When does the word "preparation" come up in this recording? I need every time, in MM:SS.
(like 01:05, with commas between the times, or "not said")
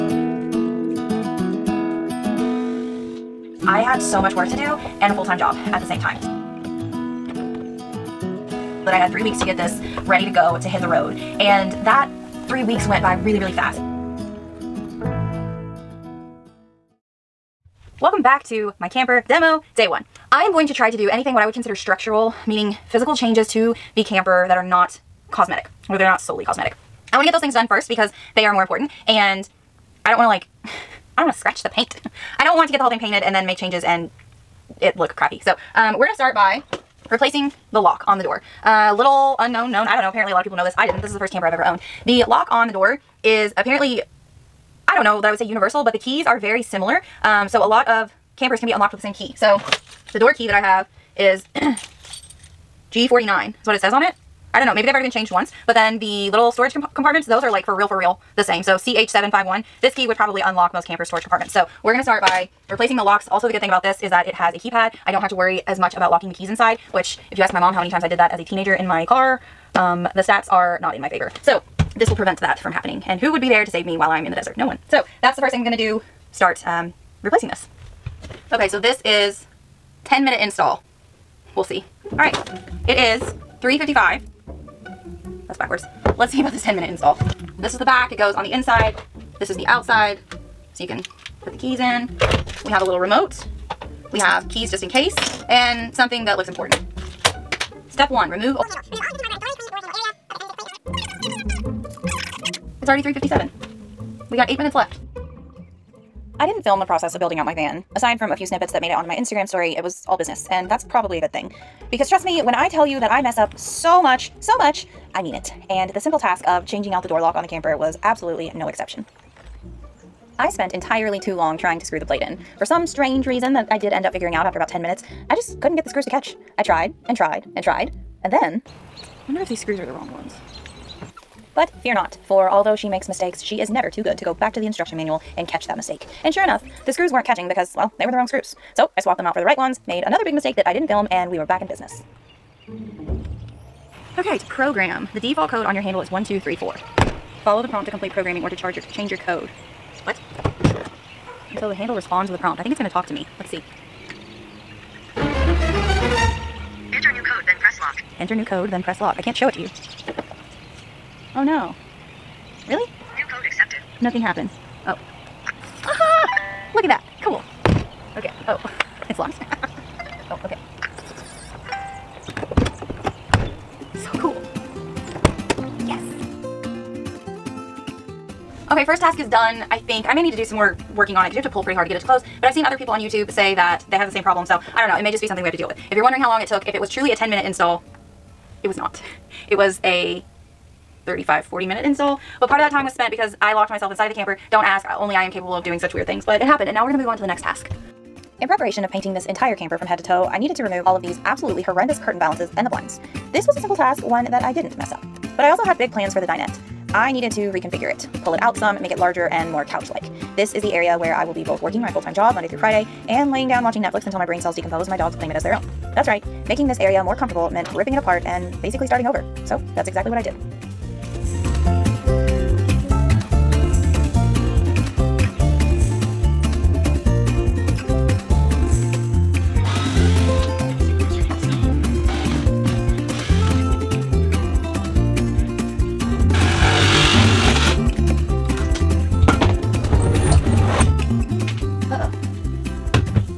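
03:18.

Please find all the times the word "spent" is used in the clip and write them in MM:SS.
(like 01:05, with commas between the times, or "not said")
02:00, 03:12.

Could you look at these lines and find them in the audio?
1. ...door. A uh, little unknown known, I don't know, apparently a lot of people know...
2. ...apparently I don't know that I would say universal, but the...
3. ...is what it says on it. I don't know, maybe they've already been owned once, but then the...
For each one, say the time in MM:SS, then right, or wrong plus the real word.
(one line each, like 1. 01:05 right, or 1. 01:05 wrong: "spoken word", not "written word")
1. 00:38 right
2. 00:43 right
3. 00:53 wrong: "changed", not "owned".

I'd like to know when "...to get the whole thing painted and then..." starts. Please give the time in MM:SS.
00:32.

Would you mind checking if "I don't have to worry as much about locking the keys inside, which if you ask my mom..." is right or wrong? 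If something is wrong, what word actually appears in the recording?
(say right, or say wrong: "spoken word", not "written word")
right.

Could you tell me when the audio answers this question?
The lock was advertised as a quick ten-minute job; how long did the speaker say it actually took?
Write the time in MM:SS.
03:11.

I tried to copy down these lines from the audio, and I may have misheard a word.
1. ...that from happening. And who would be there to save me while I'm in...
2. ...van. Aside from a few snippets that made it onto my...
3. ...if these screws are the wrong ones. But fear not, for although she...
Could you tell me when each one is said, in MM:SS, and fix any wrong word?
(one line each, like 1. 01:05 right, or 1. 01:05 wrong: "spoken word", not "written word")
1. 01:12 right
2. 01:47 right
3. 02:09 right.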